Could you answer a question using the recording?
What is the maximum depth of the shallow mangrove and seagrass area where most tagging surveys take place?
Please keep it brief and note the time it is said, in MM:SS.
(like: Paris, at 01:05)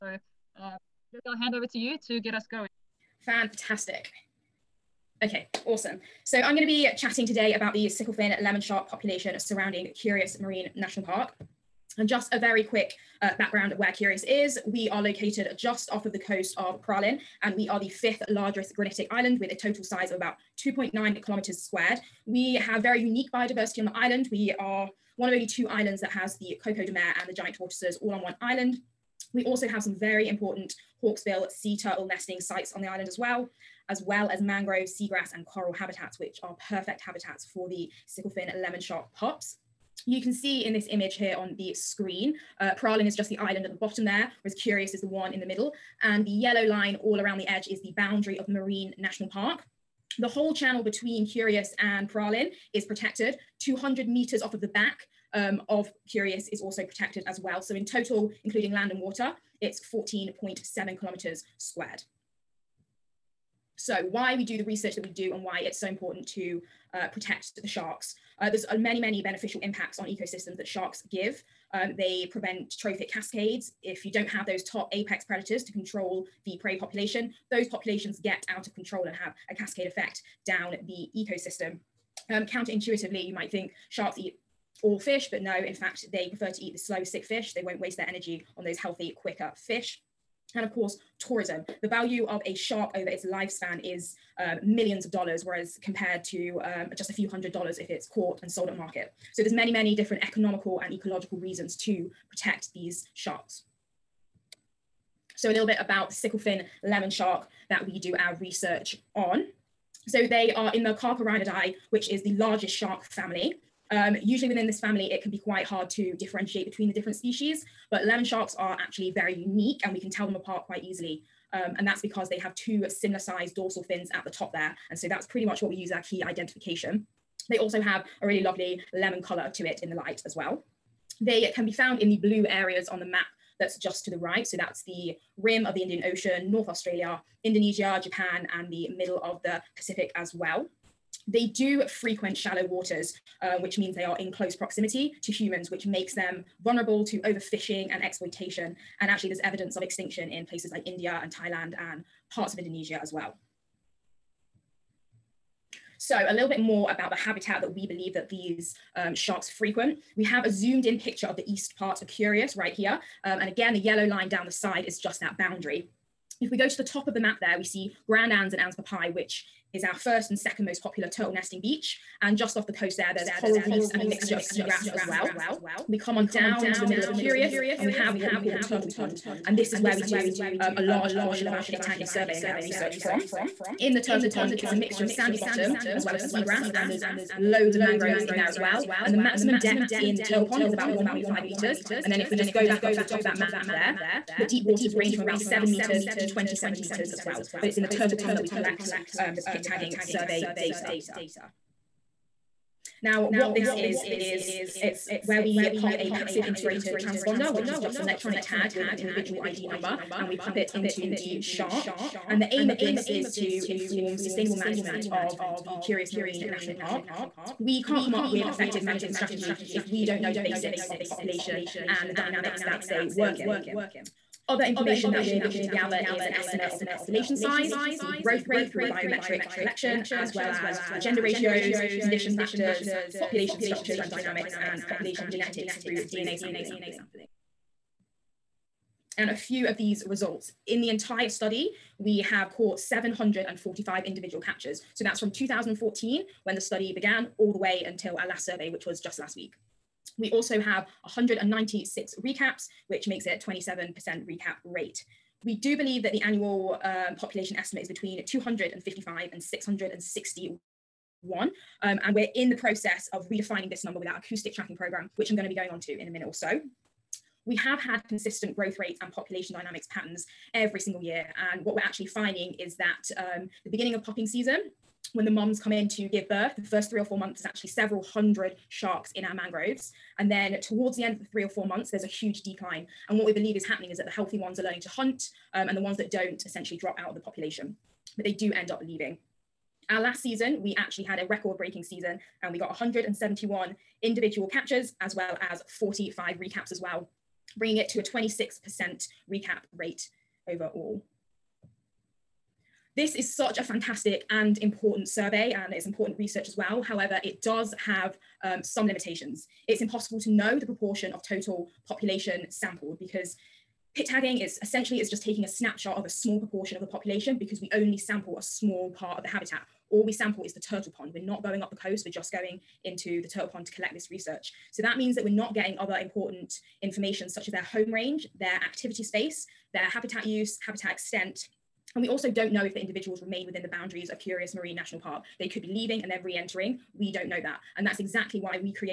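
1.5 meters, at 03:10.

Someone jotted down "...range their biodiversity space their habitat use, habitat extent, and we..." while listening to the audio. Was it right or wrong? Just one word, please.
wrong.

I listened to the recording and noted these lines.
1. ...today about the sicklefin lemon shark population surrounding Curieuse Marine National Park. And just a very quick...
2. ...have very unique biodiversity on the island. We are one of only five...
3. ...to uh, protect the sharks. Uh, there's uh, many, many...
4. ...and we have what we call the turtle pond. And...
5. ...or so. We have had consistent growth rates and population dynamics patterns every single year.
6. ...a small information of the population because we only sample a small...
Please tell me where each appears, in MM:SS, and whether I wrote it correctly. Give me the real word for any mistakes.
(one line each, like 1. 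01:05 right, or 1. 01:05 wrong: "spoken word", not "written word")
1. 00:07 right
2. 00:22 wrong: "two", not "five"
3. 01:06 right
4. 02:57 right
5. 04:26 right
6. 05:16 wrong: "proportion", not "information".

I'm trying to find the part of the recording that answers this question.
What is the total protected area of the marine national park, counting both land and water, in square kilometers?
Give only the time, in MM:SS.
00:59.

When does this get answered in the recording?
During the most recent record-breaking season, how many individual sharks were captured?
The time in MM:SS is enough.
04:52.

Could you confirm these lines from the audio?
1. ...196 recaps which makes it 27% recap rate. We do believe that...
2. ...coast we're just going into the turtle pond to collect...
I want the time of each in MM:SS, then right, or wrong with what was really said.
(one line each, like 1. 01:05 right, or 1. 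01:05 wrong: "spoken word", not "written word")
1. 04:11 right
2. 05:21 right.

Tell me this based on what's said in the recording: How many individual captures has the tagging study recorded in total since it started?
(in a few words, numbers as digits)
745.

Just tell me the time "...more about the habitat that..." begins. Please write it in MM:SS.
02:36.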